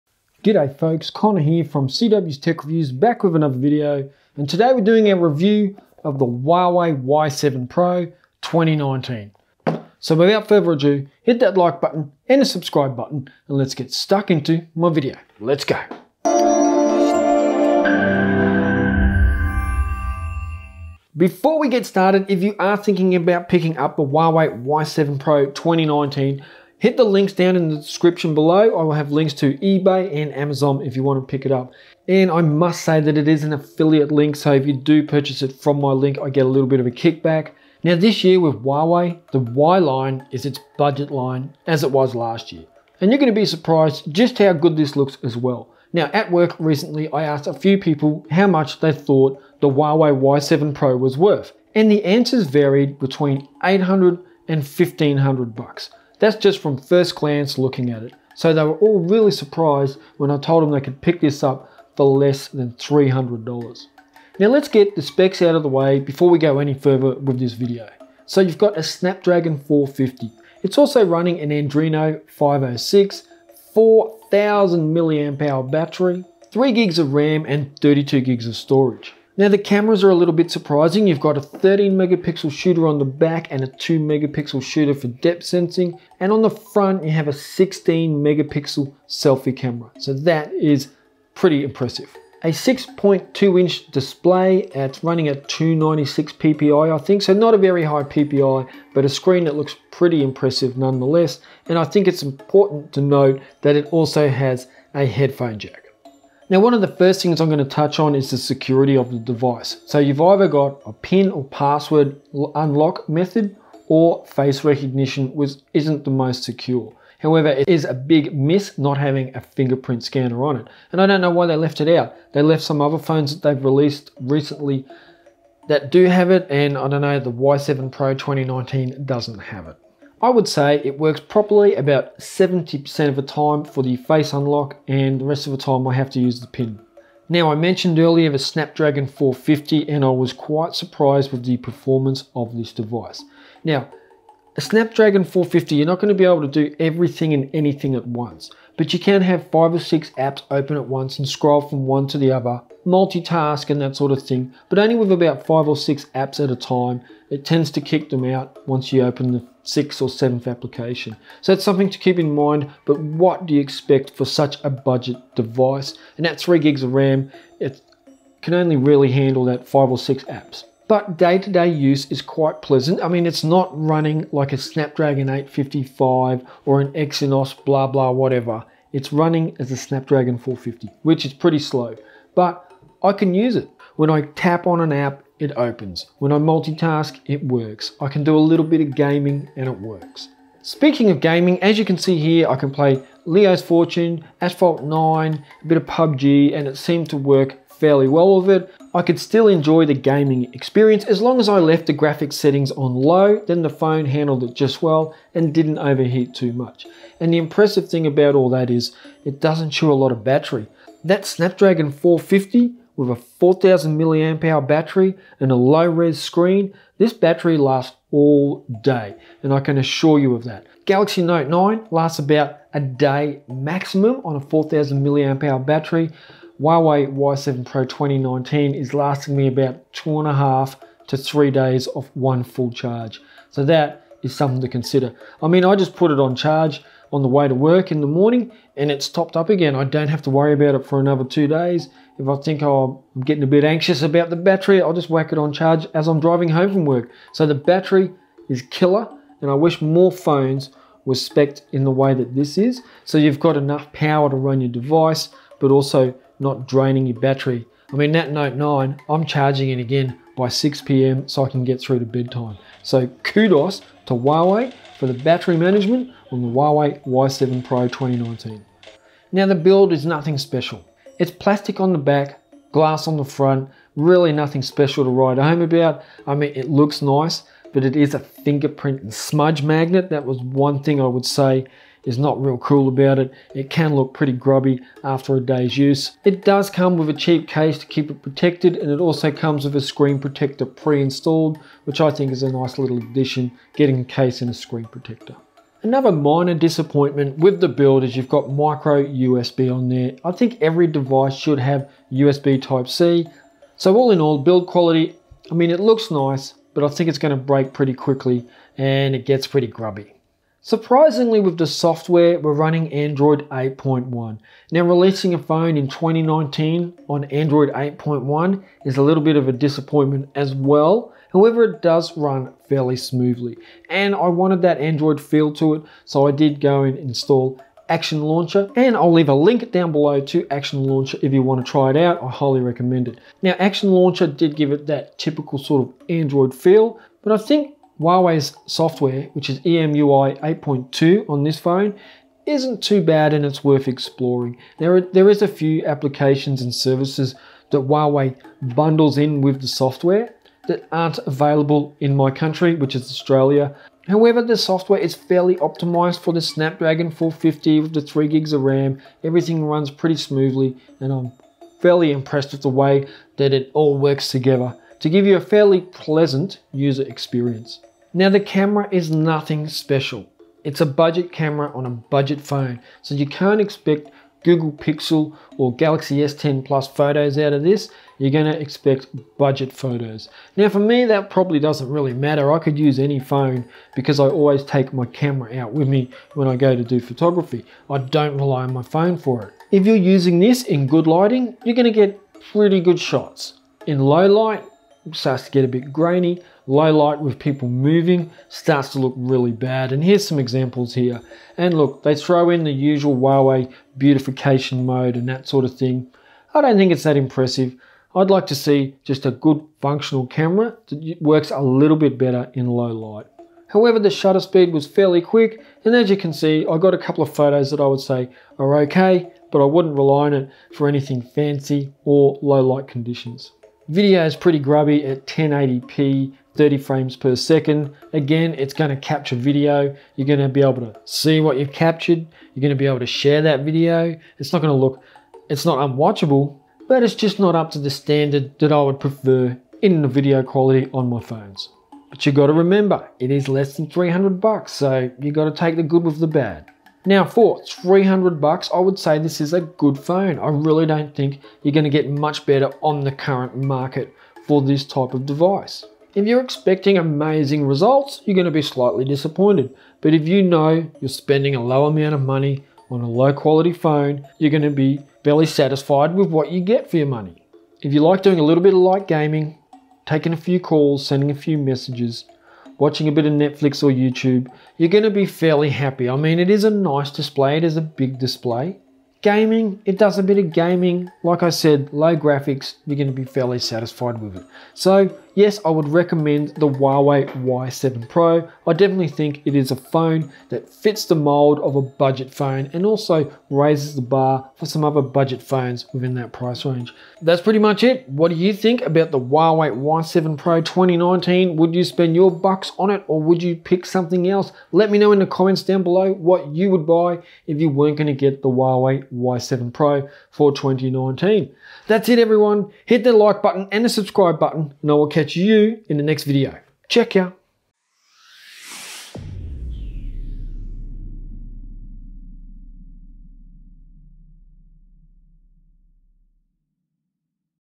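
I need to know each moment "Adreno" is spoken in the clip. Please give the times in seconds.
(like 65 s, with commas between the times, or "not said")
71 s.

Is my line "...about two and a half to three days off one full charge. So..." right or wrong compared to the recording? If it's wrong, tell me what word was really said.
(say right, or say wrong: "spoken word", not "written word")
right.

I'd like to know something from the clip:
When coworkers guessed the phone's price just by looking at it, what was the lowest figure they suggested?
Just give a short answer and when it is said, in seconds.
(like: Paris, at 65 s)
800, at 53 s.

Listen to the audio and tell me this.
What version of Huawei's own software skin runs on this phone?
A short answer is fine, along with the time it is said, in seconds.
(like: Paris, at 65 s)
EMUI 8.2, at 339 s.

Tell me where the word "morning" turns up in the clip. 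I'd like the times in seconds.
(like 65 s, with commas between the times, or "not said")
238 s.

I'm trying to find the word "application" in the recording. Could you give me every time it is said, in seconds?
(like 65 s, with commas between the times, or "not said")
160 s, 345 s.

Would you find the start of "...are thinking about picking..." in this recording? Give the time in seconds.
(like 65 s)
22 s.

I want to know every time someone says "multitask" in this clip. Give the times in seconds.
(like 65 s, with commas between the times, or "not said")
152 s, 186 s.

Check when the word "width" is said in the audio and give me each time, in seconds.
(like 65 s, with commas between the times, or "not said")
not said.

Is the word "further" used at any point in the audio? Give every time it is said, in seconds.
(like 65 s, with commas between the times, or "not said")
10 s, 66 s.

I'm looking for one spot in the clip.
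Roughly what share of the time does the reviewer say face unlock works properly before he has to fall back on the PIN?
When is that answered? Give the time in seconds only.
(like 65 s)
132 s.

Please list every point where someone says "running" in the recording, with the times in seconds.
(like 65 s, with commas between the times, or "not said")
71 s, 95 s, 173 s, 179 s, 312 s.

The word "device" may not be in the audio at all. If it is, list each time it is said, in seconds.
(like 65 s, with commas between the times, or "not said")
109 s, 142 s, 165 s, 254 s, 300 s, 455 s.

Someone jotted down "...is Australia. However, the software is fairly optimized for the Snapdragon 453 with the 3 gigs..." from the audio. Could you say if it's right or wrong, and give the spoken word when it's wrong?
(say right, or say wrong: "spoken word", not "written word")
wrong: "450", not "453".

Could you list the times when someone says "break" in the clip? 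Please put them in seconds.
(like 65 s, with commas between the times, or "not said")
307 s.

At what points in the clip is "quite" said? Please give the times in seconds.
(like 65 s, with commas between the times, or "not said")
140 s, 172 s.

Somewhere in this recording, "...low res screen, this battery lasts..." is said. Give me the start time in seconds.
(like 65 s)
215 s.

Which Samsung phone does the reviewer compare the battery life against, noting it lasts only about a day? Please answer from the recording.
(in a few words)
Galaxy Note 9.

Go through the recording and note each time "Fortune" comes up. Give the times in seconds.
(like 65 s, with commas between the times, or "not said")
193 s.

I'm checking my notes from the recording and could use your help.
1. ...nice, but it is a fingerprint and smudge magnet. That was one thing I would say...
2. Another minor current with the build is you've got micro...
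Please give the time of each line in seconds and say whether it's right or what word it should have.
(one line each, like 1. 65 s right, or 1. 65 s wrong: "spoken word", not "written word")
1. 277 s right
2. 295 s wrong: "disappointment", not "current".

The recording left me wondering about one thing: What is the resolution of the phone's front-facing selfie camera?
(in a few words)
16 megapixel.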